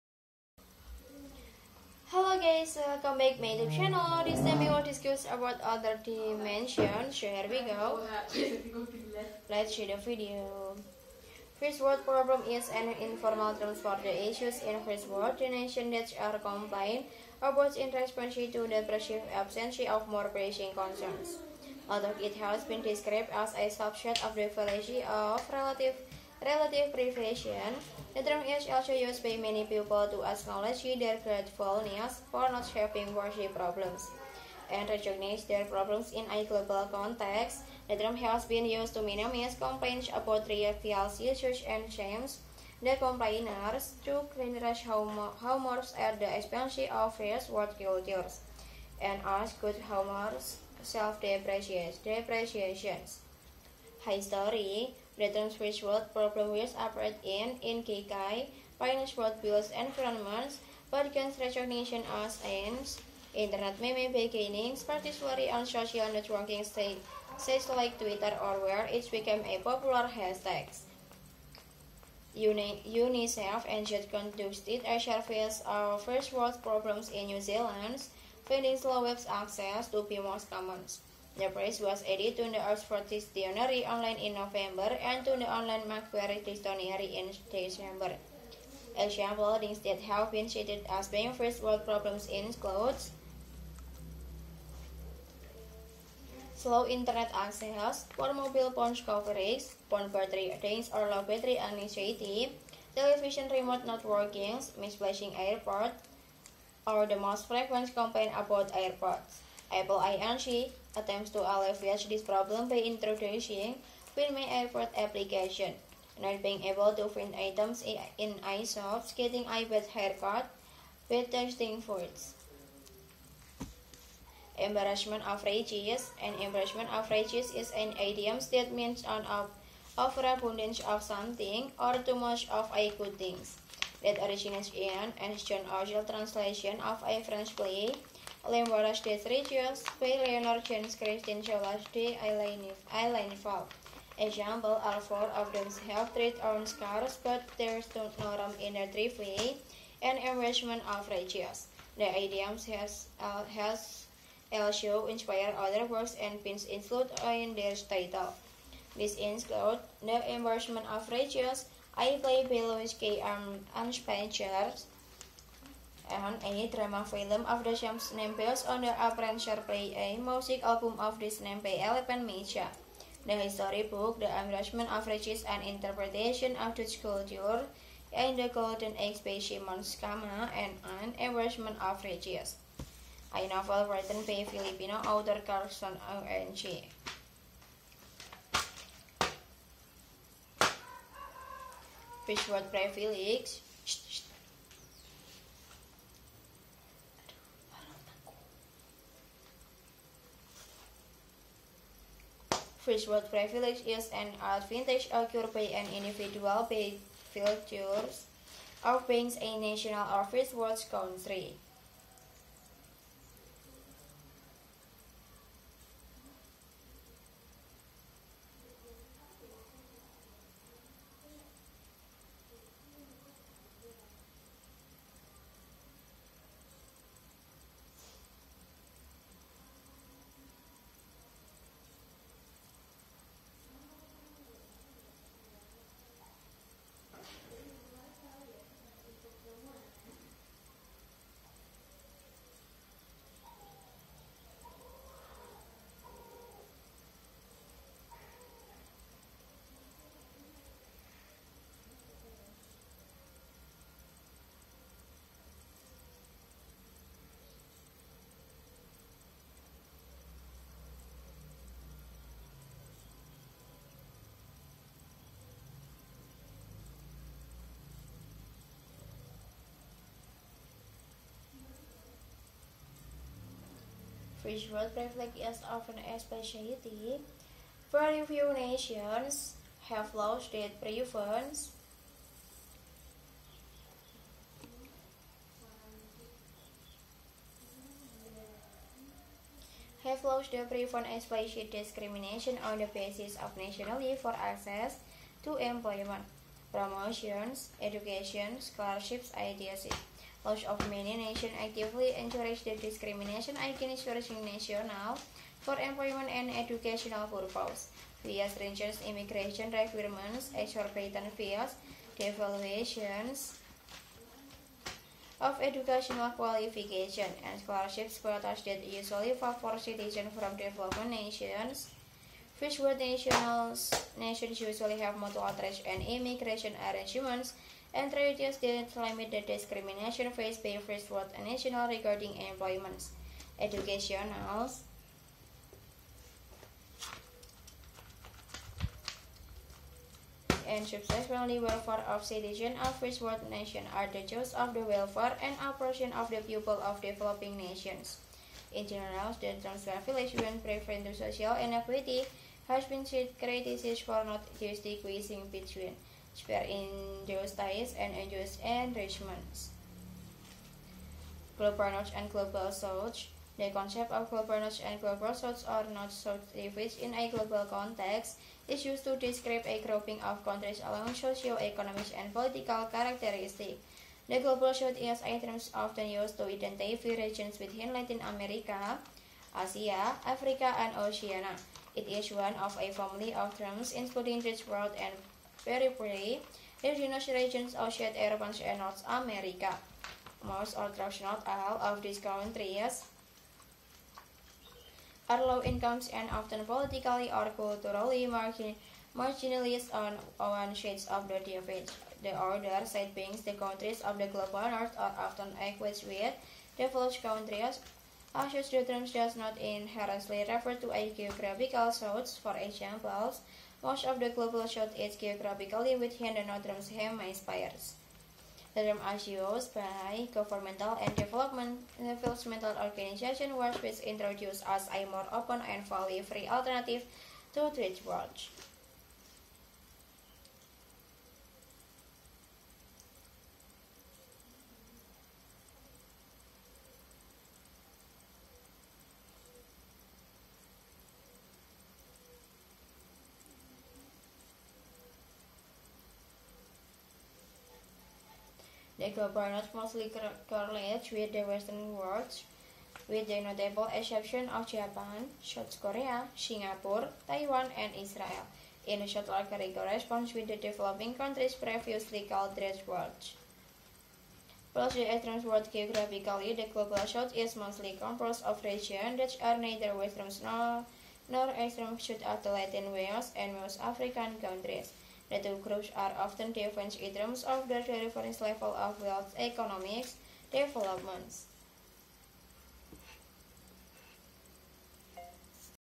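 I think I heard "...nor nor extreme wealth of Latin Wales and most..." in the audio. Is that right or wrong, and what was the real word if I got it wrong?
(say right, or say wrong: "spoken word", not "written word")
wrong: "south", not "wealth".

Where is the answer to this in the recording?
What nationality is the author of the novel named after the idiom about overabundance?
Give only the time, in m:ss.
3:04.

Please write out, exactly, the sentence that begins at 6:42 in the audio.
The other side being the countries of the global north are often equated with developed countries.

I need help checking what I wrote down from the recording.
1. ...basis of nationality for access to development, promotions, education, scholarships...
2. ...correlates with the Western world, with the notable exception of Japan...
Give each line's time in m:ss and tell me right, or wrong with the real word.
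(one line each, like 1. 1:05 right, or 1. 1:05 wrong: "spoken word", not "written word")
1. 4:52 wrong: "employment", not "development"
2. 7:30 right.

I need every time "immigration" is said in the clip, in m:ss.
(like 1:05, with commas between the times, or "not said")
5:09, 5:26.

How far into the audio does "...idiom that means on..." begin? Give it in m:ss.
2:07.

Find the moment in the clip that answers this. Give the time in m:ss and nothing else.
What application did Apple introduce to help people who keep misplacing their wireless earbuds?
1:54.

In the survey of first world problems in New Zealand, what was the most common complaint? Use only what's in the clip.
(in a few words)
slow web access.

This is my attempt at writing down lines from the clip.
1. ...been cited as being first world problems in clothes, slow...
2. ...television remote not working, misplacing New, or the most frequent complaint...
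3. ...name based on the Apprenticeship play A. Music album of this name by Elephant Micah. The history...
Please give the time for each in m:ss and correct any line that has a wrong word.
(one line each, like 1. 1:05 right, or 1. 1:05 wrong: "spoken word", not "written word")
1. 1:30 right
2. 1:42 wrong: "AirPods", not "New"
3. 2:48 right.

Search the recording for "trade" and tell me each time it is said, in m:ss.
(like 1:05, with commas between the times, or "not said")
5:25, 7:07.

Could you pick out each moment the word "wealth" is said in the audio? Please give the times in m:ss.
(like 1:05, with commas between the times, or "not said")
7:59.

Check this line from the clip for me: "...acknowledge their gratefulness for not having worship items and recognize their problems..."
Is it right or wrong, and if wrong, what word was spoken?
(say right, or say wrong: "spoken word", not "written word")
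wrong: "problems", not "items".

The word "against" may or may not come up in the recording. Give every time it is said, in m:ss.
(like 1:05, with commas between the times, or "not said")
1:00, 5:03.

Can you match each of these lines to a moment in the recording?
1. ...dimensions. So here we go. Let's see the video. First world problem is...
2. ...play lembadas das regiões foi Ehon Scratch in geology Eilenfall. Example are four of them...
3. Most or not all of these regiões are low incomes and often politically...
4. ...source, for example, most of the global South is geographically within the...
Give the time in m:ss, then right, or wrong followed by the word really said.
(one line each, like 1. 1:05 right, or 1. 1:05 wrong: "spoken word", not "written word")
1. 0:06 right
2. 2:17 wrong: "Leonor", not "Ehon"
3. 6:30 wrong: "countries", not "regiões"
4. 6:51 right.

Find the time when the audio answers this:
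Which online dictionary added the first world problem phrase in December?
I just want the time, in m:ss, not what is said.
1:25.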